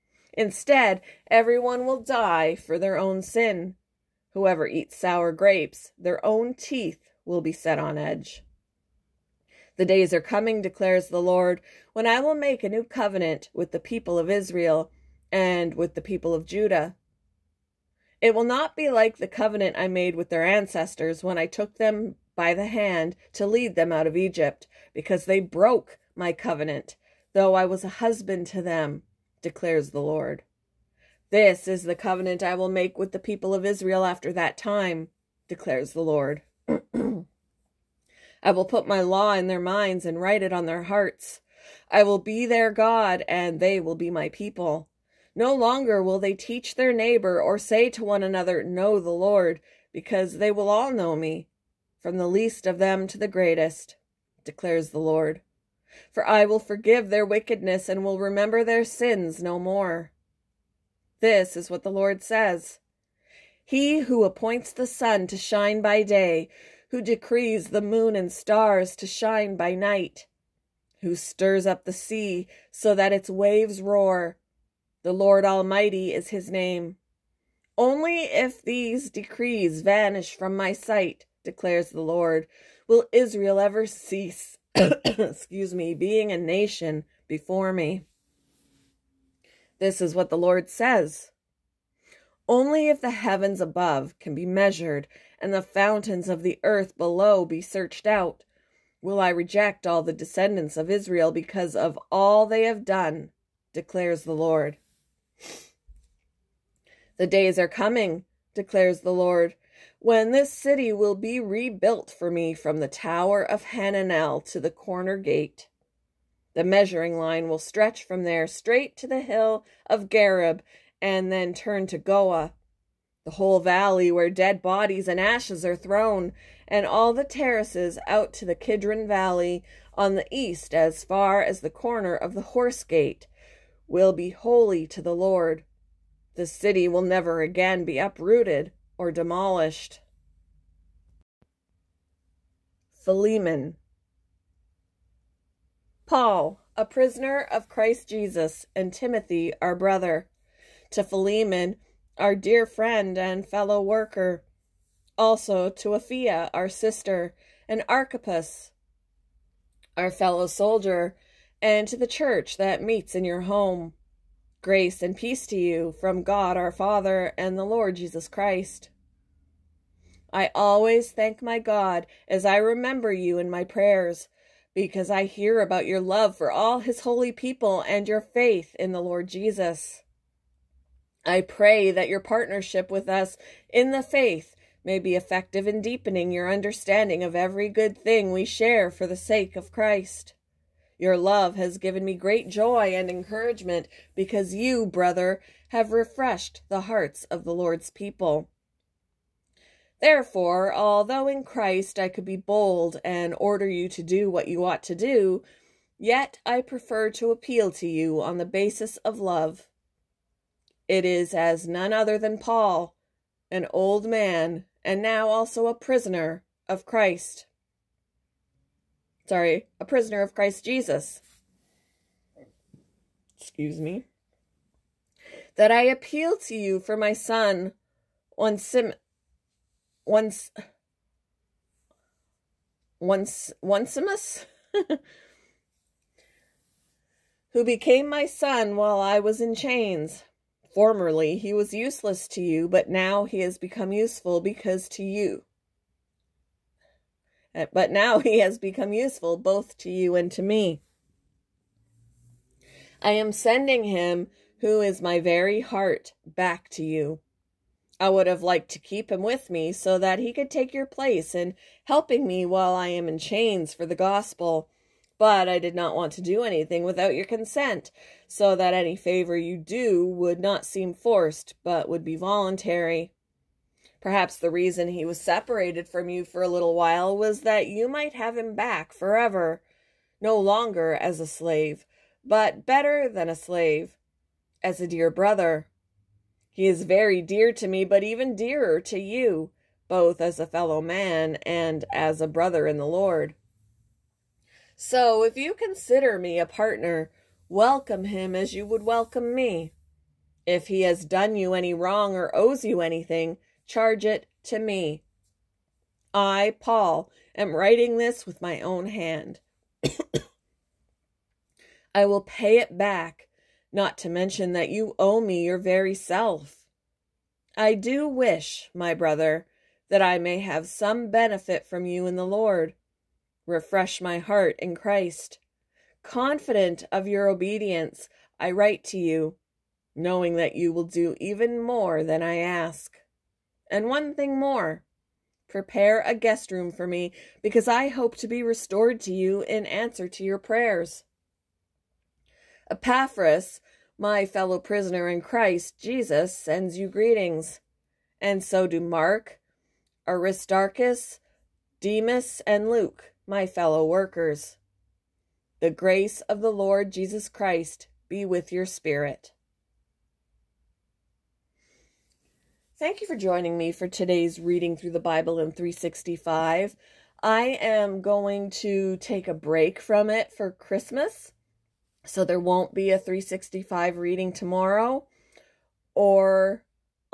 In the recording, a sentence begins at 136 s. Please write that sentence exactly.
The city will never again be uprooted or demolished.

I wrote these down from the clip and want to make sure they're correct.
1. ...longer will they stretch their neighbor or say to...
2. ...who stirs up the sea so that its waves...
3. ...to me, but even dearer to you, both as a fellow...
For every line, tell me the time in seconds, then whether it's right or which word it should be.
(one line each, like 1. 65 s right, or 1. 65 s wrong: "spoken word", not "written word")
1. 45 s wrong: "teach", not "stretch"
2. 71 s right
3. 287 s right.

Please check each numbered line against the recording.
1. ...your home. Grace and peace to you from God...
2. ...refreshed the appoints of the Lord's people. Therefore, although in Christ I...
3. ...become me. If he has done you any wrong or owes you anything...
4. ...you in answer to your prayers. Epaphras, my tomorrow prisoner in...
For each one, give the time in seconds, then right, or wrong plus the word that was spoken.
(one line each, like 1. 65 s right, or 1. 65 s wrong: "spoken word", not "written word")
1. 163 s right
2. 195 s wrong: "hearts", not "appoints"
3. 298 s wrong: "welcome", not "become"
4. 339 s wrong: "fellow", not "tomorrow".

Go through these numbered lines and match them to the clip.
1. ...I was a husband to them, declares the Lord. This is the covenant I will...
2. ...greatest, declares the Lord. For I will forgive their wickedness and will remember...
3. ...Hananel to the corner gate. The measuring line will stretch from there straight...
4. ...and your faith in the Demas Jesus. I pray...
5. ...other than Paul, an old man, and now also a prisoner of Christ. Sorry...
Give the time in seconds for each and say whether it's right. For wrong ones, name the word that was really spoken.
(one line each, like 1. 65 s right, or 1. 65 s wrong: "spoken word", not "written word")
1. 27 s right
2. 53 s right
3. 113 s right
4. 177 s wrong: "Lord", not "Demas"
5. 211 s right.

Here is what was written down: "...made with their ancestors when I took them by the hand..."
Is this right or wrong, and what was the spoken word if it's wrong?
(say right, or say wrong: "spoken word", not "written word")
right.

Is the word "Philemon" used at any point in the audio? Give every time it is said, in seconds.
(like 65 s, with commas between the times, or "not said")
142 s, 151 s.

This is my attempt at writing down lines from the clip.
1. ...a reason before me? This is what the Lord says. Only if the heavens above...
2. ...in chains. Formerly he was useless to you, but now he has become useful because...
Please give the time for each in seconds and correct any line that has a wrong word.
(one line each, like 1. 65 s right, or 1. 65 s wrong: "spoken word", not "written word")
1. 86 s wrong: "nation", not "reason"
2. 239 s right.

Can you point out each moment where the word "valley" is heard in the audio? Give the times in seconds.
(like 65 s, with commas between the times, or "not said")
123 s, 129 s.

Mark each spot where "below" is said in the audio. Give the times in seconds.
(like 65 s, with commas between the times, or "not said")
96 s.